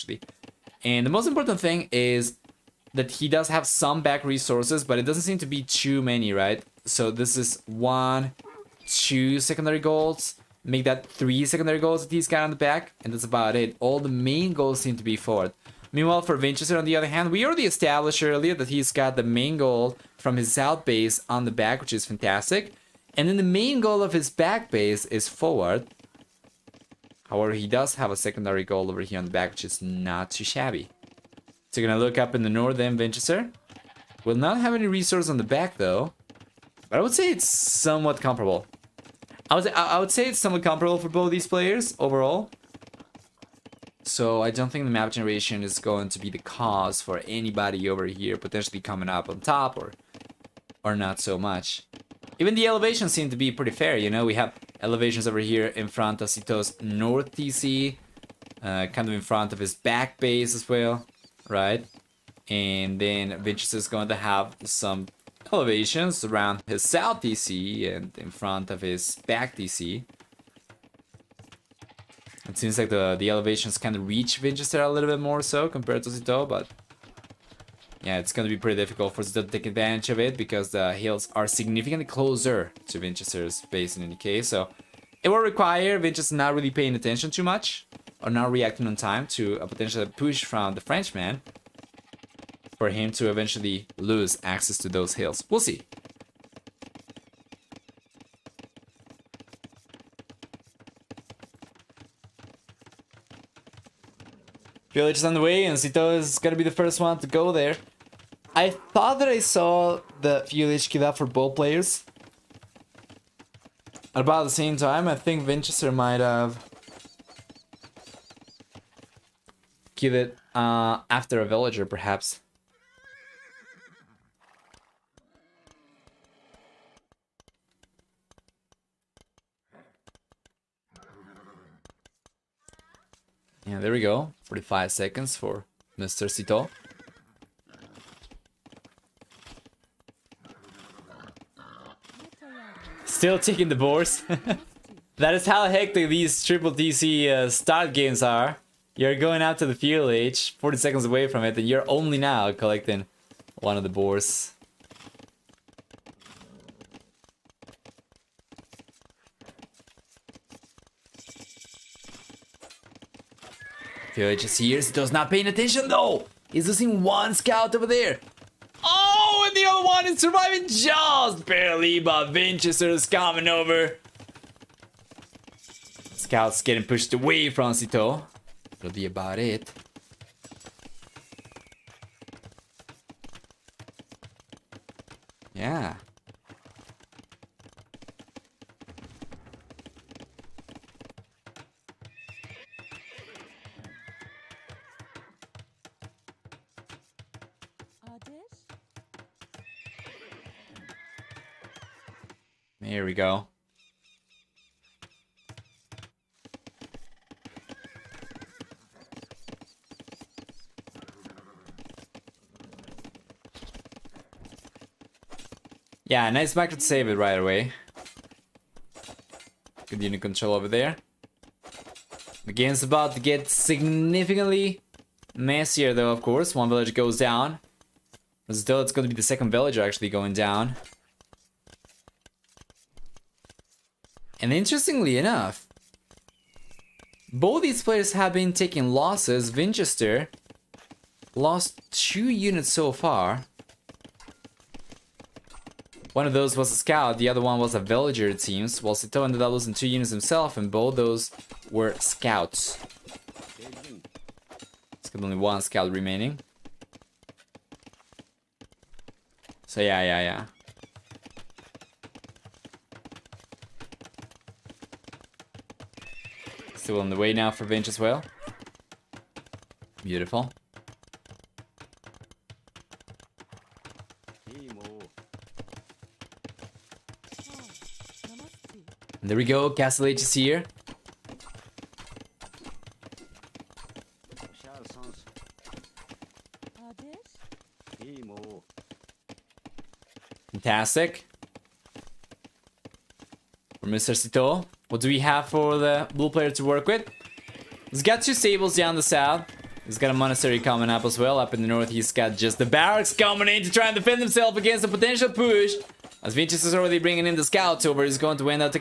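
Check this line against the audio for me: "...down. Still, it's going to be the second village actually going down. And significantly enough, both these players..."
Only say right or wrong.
wrong.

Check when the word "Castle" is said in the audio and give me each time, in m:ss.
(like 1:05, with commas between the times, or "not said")
4:39.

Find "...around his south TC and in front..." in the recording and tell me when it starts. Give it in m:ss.
1:06.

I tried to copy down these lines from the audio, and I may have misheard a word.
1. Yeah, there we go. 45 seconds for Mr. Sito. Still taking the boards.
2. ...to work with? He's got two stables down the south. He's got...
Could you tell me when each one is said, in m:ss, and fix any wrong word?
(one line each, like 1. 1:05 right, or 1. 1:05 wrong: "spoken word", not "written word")
1. 2:13 right
2. 4:56 right.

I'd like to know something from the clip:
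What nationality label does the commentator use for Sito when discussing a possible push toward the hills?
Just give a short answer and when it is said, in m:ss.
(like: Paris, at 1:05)
Frenchman, at 1:30.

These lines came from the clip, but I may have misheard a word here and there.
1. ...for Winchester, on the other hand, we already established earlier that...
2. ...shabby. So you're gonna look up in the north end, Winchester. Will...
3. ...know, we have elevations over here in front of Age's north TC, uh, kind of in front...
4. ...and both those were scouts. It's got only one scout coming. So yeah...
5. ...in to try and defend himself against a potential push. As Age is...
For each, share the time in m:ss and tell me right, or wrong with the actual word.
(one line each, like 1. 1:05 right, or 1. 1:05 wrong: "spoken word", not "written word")
1. 0:16 right
2. 0:30 right
3. 0:54 wrong: "Sito", not "Age"
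4. 4:10 wrong: "remaining", not "coming"
5. 5:03 wrong: "Vinicius", not "Age".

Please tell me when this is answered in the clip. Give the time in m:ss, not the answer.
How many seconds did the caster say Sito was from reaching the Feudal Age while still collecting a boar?
2:30.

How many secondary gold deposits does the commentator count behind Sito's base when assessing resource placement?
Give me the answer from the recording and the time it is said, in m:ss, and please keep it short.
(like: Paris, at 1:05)
3, at 0:11.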